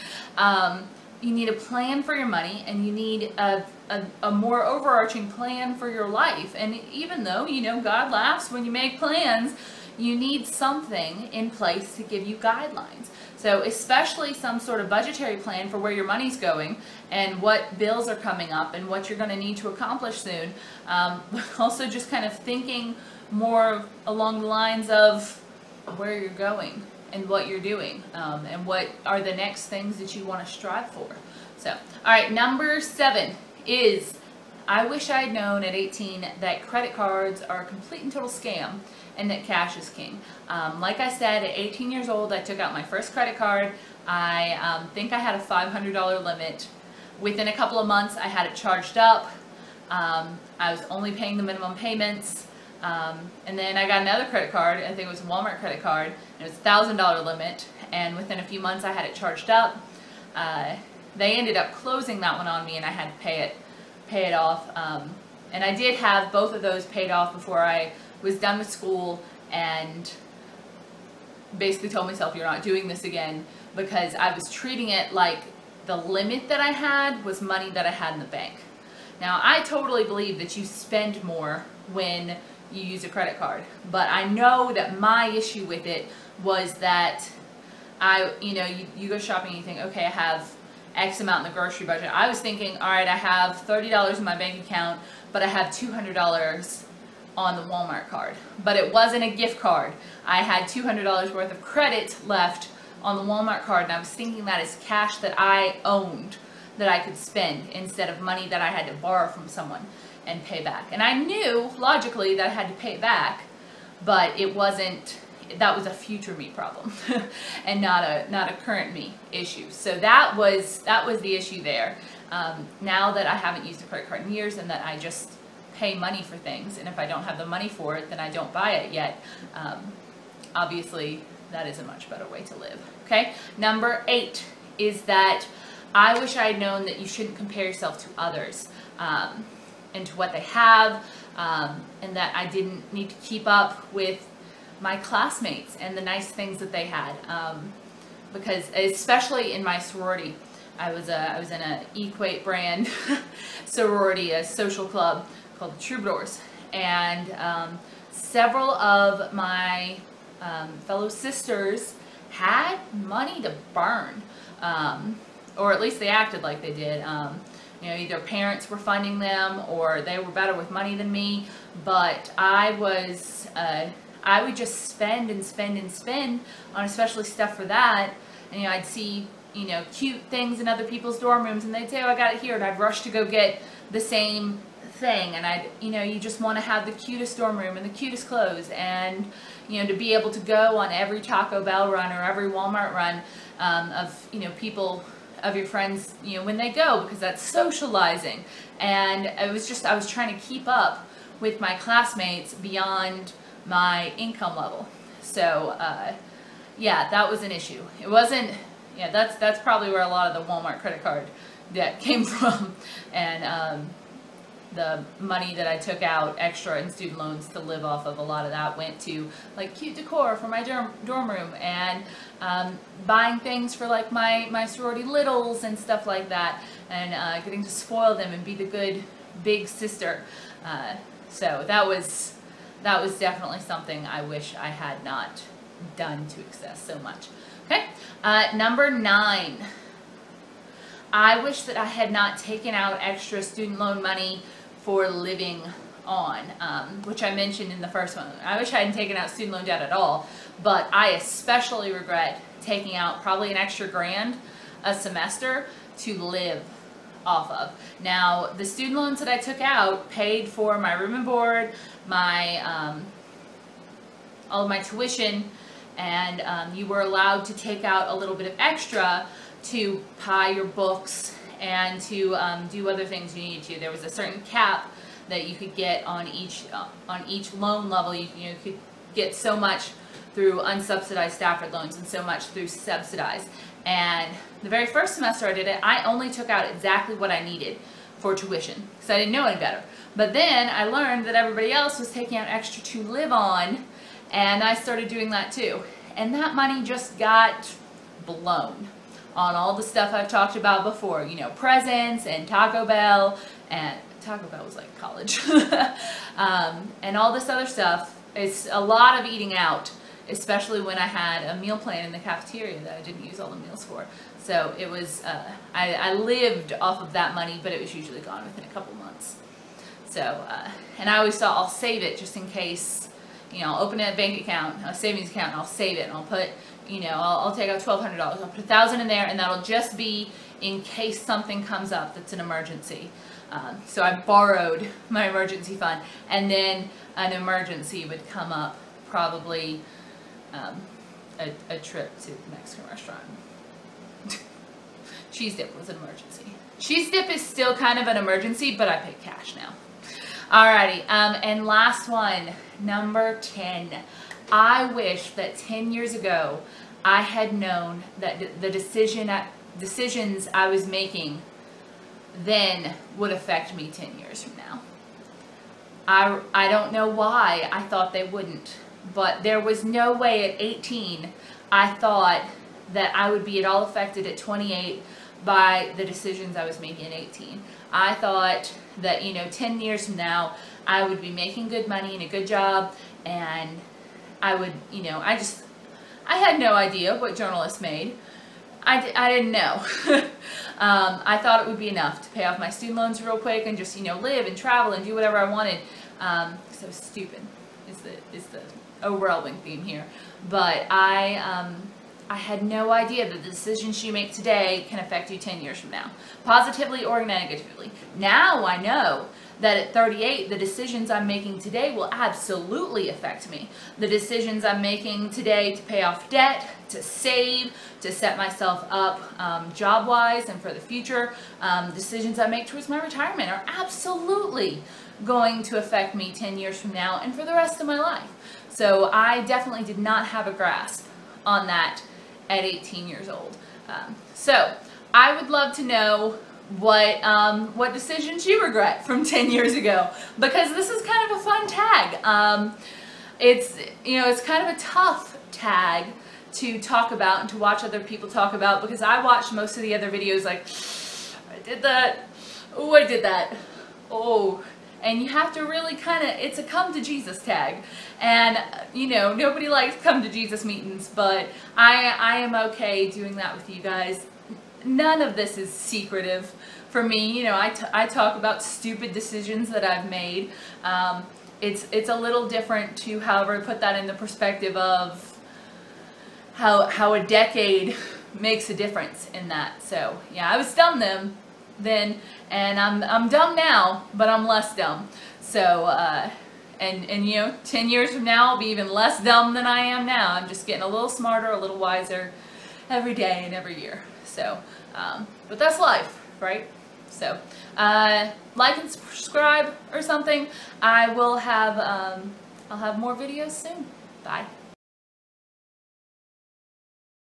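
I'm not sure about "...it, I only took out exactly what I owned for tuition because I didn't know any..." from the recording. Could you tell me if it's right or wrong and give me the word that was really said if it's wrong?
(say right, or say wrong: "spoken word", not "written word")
wrong: "needed", not "owned".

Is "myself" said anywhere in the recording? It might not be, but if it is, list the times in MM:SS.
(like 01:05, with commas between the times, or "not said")
01:12, 06:58.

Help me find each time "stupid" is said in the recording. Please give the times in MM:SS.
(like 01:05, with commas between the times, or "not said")
06:36, 07:48.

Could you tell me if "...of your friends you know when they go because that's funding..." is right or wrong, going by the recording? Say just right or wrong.
wrong.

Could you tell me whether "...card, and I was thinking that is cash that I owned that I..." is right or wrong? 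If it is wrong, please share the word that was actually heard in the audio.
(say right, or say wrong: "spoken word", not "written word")
right.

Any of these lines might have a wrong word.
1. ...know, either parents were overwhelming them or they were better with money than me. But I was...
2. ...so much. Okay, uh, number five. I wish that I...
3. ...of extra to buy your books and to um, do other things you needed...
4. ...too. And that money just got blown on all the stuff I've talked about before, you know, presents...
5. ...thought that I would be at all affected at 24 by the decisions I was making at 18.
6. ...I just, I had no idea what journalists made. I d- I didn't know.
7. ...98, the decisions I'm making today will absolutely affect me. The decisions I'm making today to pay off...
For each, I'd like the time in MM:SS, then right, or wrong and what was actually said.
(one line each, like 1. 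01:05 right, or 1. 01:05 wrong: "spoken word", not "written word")
1. 02:47 wrong: "funding", not "overwhelming"
2. 03:56 wrong: "nine", not "five"
3. 04:28 right
4. 04:55 right
5. 06:11 wrong: "28", not "24"
6. 06:25 right
7. 06:49 wrong: "38", not "98".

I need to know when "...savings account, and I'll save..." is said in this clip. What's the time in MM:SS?
05:24.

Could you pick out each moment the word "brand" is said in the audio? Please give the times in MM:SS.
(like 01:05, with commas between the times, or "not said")
02:32.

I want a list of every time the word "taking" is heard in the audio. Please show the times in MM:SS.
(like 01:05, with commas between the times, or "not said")
04:12, 04:52.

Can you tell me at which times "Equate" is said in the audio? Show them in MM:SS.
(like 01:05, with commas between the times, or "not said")
02:31.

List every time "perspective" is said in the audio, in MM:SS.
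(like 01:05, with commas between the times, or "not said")
07:54.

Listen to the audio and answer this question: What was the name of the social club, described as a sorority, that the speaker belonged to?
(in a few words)
Troubadours.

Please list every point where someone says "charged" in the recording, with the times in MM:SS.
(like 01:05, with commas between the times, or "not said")
00:48, 00:59.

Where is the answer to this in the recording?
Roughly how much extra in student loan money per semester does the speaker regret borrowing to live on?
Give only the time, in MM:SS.
04:13.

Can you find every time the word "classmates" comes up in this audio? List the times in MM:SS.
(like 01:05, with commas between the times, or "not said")
02:24, 03:21.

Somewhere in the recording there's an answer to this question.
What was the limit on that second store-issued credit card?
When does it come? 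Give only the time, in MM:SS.
00:56.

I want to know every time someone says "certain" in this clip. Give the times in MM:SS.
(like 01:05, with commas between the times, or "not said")
04:34.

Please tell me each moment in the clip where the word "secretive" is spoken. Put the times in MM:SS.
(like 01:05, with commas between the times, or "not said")
07:45.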